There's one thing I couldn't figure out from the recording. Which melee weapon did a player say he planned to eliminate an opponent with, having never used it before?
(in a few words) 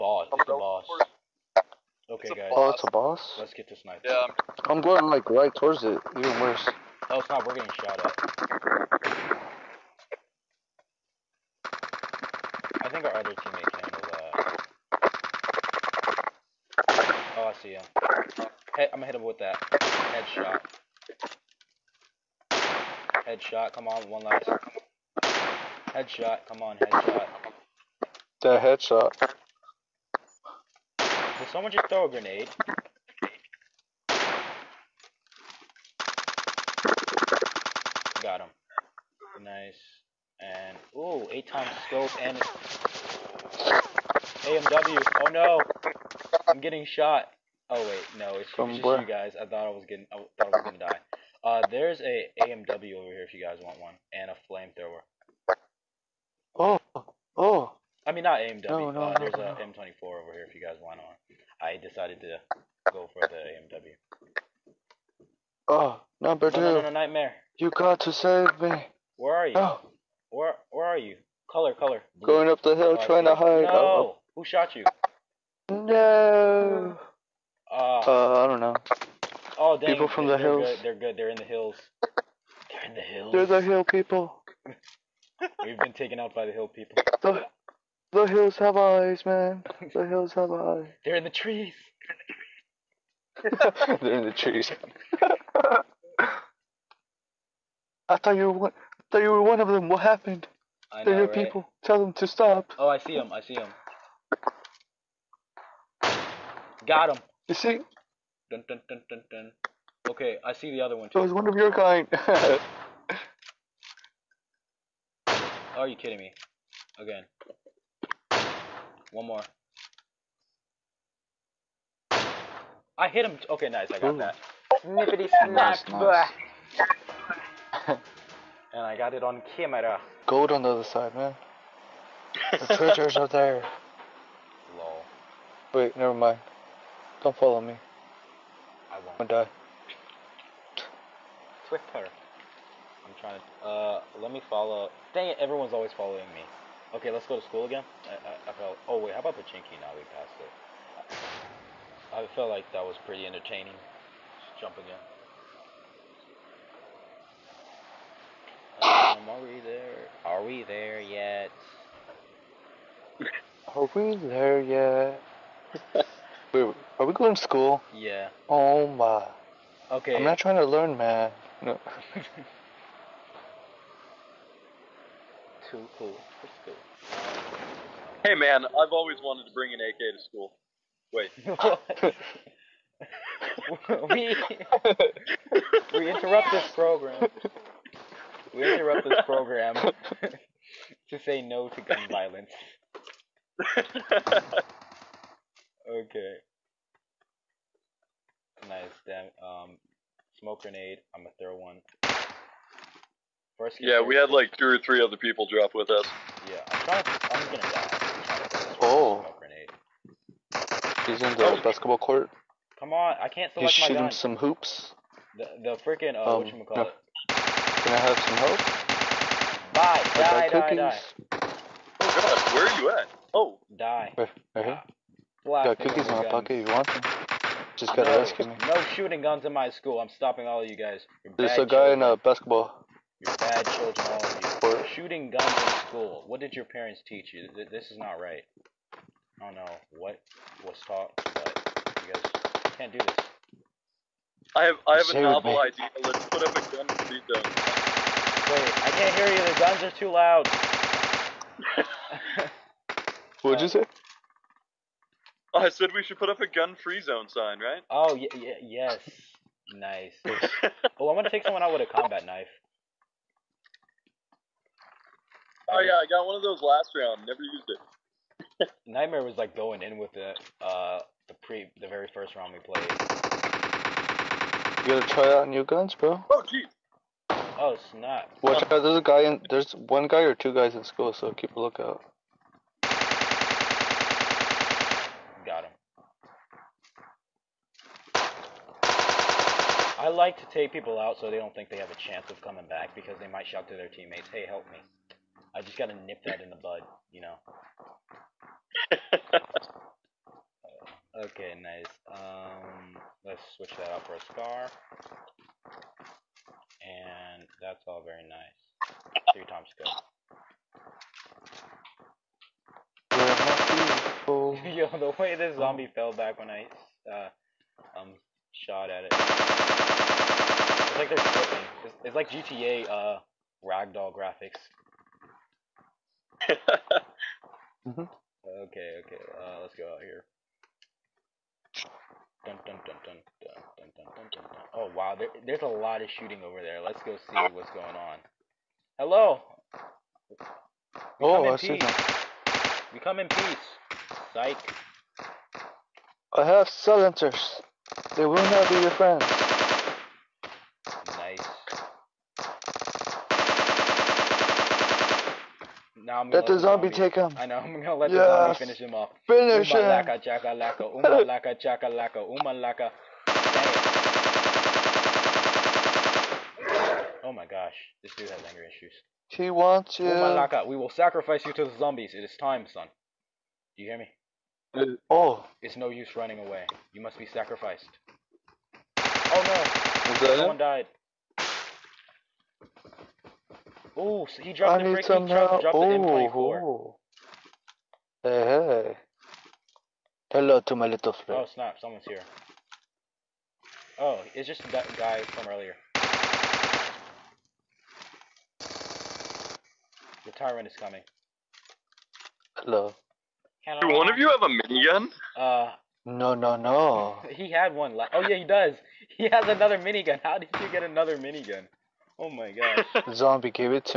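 combat knife.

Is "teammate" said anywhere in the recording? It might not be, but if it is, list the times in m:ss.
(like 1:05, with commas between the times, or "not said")
0:13, 4:53.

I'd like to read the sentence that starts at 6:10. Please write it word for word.
We will sacrifice you to the zombies.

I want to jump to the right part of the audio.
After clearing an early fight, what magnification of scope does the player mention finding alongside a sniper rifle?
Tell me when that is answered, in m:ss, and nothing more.
0:41.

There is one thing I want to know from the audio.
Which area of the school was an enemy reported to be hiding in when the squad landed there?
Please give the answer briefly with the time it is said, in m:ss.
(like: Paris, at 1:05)
basketball court, at 3:31.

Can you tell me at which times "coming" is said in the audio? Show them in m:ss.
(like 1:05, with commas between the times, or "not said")
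4:52, 6:40.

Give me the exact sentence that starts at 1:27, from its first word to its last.
The, the hills have eyes, man.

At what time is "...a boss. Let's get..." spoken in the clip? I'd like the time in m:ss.
0:02.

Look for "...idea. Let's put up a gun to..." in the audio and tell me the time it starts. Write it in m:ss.
4:05.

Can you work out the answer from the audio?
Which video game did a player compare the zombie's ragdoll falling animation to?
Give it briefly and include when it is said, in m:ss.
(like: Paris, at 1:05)
GTA, at 5:22.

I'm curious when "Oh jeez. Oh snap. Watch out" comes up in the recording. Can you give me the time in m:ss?
4:36.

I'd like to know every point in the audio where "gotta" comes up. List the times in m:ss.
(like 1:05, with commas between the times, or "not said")
3:47, 4:34, 4:55.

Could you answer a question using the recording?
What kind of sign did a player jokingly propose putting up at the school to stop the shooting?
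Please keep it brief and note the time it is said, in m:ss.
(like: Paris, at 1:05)
gun-free zone, at 4:16.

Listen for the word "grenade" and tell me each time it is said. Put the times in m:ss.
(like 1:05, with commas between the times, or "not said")
0:32, 3:20.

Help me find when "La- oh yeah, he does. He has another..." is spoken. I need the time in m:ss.
6:47.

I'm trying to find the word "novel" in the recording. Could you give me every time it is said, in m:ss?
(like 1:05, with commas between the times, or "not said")
4:05.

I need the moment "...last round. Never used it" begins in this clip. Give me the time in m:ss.
4:26.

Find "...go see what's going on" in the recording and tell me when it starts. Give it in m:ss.
5:37.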